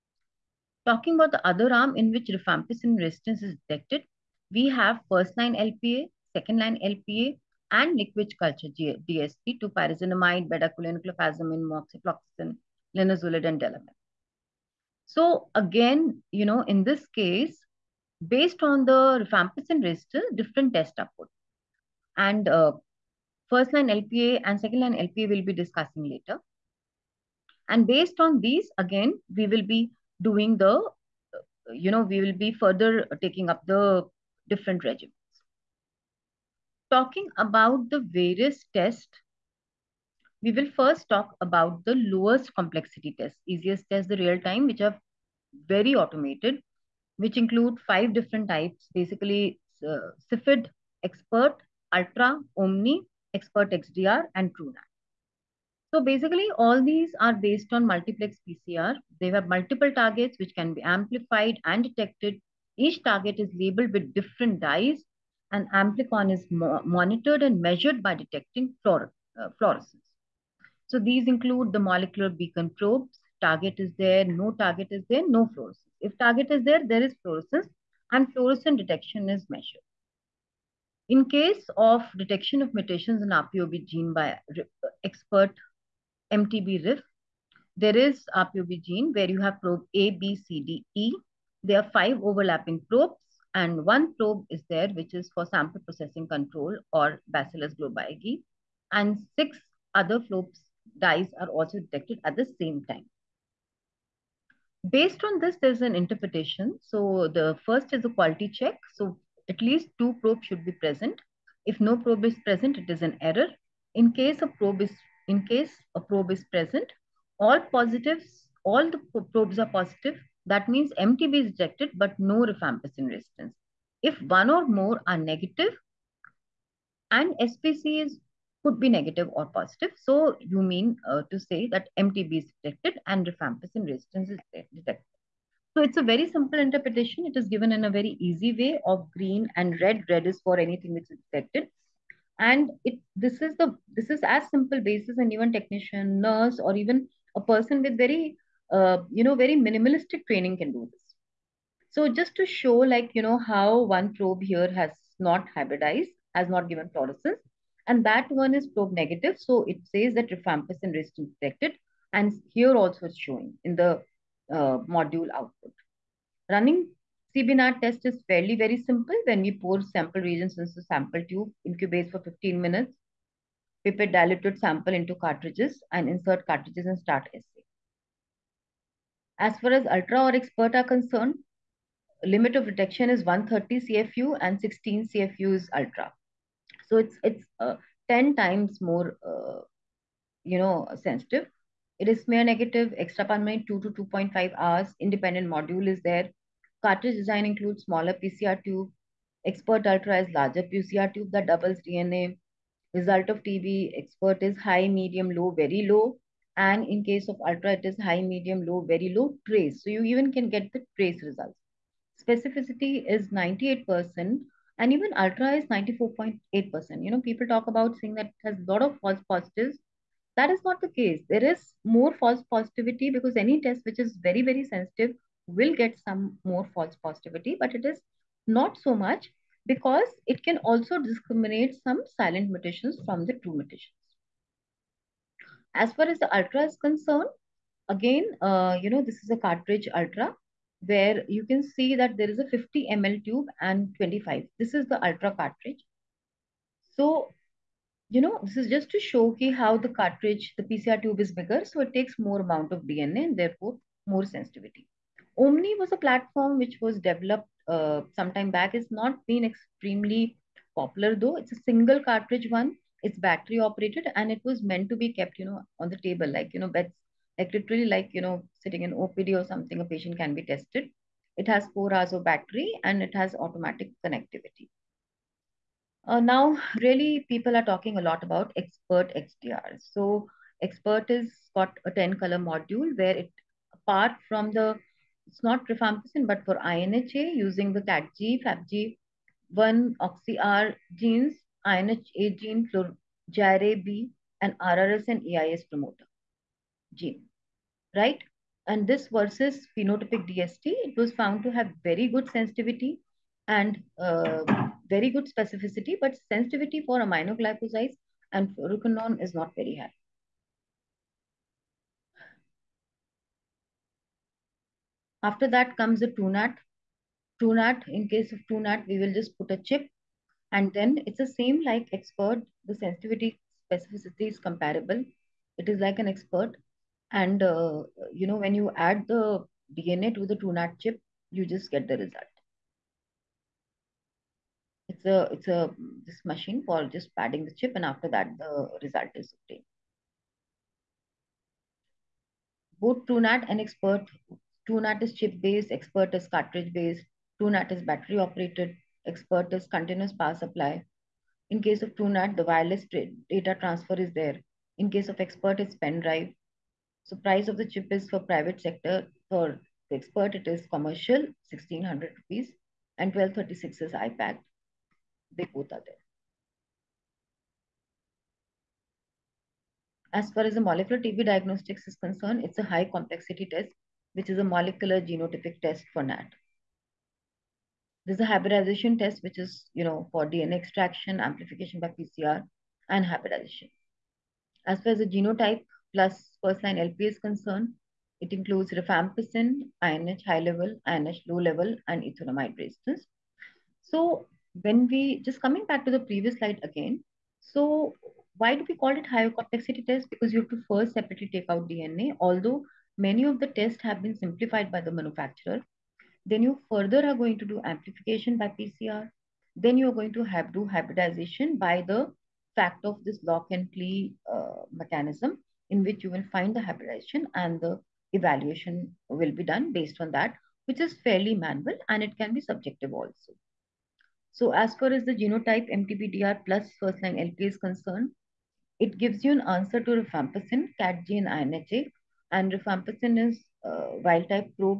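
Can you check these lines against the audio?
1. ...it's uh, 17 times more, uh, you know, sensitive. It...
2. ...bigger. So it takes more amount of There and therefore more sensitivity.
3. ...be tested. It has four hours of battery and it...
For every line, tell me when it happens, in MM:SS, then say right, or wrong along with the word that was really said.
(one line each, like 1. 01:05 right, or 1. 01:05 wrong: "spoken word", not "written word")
1. 03:07 wrong: "10", not "17"
2. 04:11 wrong: "DNA", not "There"
3. 04:30 right.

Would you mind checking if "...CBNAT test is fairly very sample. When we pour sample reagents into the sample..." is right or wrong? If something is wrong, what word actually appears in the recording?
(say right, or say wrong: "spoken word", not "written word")
wrong: "simple", not "sample".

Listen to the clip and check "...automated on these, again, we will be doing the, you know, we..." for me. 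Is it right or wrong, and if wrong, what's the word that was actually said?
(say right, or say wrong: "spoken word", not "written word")
wrong: "based", not "automated".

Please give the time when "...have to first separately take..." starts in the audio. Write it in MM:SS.
06:40.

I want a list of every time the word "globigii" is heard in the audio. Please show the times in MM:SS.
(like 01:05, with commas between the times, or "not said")
01:37.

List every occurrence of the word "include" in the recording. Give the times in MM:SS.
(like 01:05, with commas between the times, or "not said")
00:47, 01:11, 03:17, 06:28.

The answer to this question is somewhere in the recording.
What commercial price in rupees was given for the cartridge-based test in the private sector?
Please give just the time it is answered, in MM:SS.
06:01.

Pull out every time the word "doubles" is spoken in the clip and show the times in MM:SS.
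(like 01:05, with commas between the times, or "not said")
03:21.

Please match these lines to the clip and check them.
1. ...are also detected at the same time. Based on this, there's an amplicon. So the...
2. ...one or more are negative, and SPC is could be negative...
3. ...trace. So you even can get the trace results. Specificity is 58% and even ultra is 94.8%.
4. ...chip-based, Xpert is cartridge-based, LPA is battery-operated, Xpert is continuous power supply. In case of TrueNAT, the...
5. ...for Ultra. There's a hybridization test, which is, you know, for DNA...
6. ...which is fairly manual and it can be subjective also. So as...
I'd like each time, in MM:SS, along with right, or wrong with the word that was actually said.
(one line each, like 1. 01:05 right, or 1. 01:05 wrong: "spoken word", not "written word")
1. 01:41 wrong: "interpretation", not "amplicon"
2. 02:04 right
3. 03:29 wrong: "98", not "58"
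4. 05:45 wrong: "TrueNAT", not "LPA"
5. 06:15 wrong: "NAT", not "Ultra"
6. 07:00 right.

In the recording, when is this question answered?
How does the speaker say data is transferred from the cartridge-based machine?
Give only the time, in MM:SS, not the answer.
05:55.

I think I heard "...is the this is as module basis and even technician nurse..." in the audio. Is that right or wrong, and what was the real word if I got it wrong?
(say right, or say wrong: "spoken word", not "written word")
wrong: "simple", not "module".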